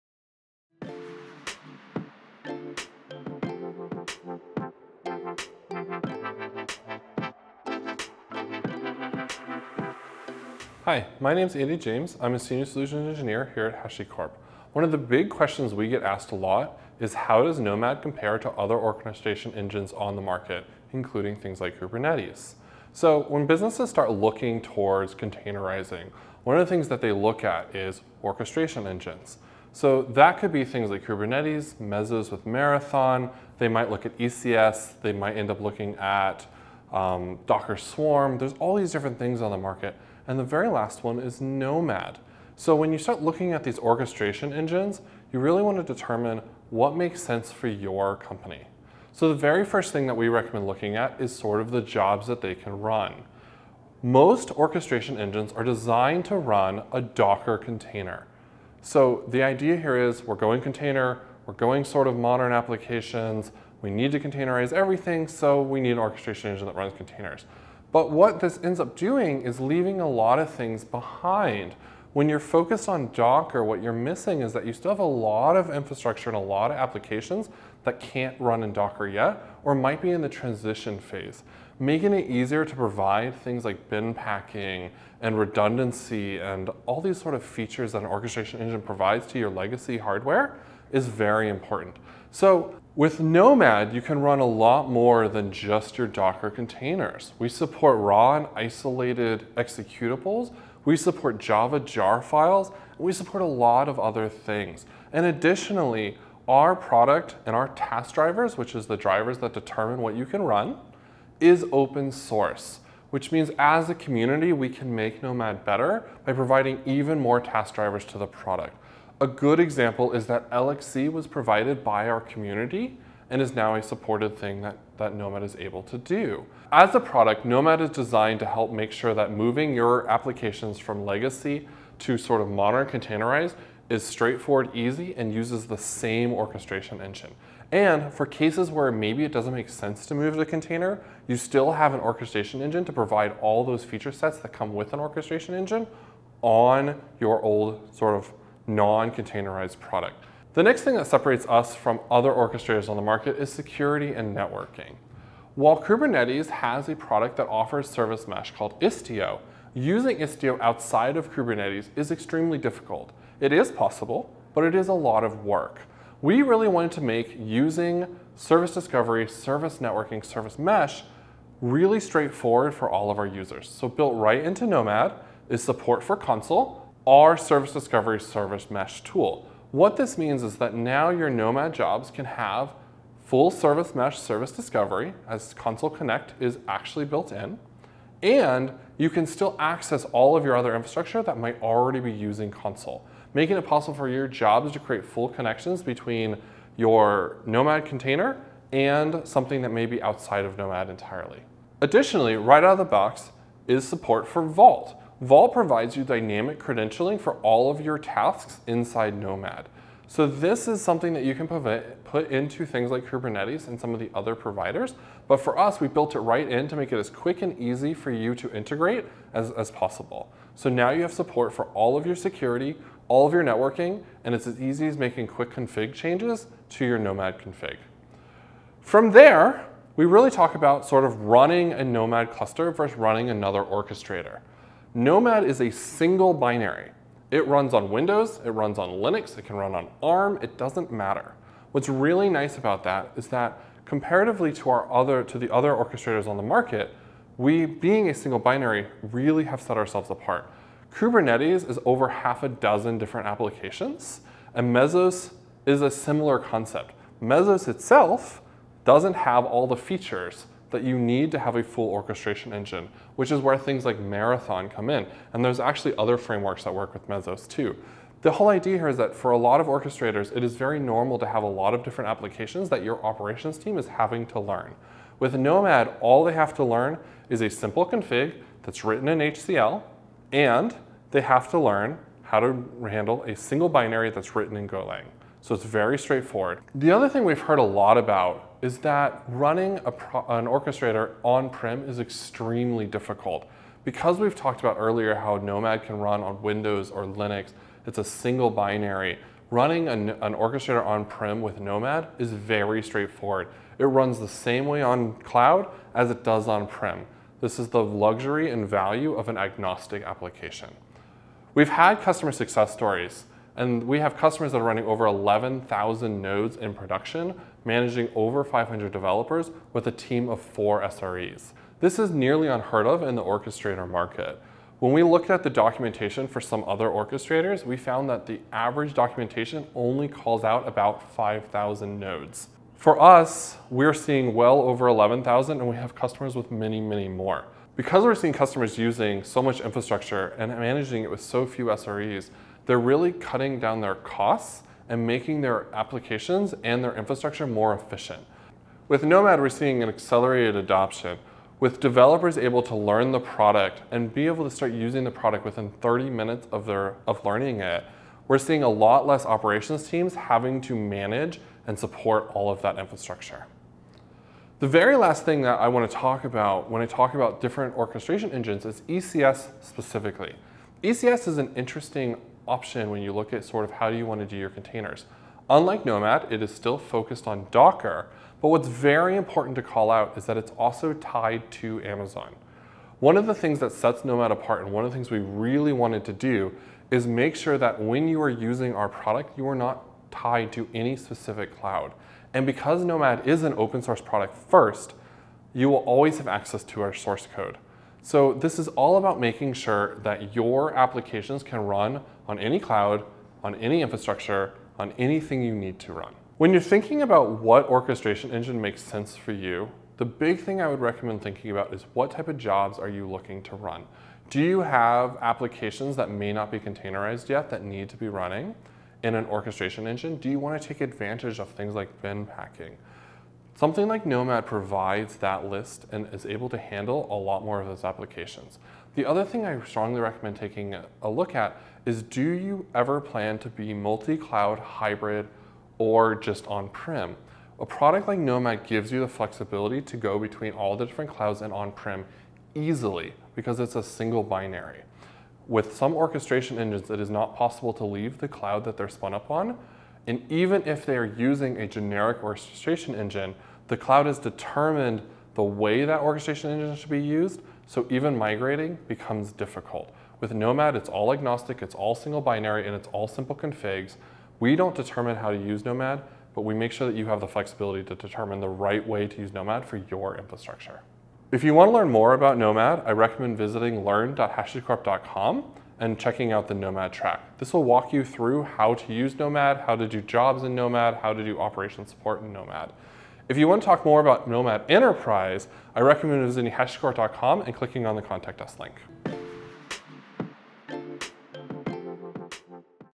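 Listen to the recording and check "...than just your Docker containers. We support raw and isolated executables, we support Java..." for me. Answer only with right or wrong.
right.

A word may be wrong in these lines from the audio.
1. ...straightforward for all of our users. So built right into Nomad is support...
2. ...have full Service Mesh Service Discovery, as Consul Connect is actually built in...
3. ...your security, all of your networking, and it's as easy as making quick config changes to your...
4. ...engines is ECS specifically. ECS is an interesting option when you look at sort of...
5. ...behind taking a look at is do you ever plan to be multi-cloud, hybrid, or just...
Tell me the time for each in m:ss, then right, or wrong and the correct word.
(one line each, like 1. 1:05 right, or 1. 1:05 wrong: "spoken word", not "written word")
1. 2:51 right
2. 3:02 right
3. 3:42 right
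4. 6:08 right
5. 7:10 wrong: "recommend", not "behind".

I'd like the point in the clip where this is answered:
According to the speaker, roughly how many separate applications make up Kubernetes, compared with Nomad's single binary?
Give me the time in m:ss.
4:11.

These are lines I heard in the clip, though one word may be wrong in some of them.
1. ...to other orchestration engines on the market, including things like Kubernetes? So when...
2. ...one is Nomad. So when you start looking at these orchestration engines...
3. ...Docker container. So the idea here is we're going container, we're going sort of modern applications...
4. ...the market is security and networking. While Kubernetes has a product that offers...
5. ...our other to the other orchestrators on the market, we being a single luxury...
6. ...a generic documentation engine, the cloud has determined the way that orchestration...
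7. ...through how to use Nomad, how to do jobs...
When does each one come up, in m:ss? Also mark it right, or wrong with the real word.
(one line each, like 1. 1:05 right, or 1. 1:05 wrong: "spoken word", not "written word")
1. 0:18 right
2. 0:41 right
3. 0:57 right
4. 2:32 right
5. 4:04 wrong: "binary", not "luxury"
6. 7:31 wrong: "orchestration", not "documentation"
7. 7:58 right.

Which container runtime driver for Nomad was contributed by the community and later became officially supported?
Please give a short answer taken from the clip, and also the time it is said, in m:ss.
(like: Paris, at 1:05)
LXC, at 2:00.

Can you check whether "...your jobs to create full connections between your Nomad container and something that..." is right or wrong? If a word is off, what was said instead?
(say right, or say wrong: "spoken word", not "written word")
right.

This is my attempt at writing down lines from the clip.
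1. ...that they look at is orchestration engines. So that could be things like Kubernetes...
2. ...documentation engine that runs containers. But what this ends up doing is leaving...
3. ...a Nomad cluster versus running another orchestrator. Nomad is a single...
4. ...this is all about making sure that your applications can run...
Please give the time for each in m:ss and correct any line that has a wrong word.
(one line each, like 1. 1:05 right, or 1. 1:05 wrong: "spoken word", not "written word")
1. 0:26 right
2. 1:05 wrong: "orchestration", not "documentation"
3. 3:51 right
4. 6:38 right.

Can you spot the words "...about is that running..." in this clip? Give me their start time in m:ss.
4:47.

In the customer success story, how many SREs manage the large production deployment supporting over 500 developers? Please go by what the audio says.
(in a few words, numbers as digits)
4.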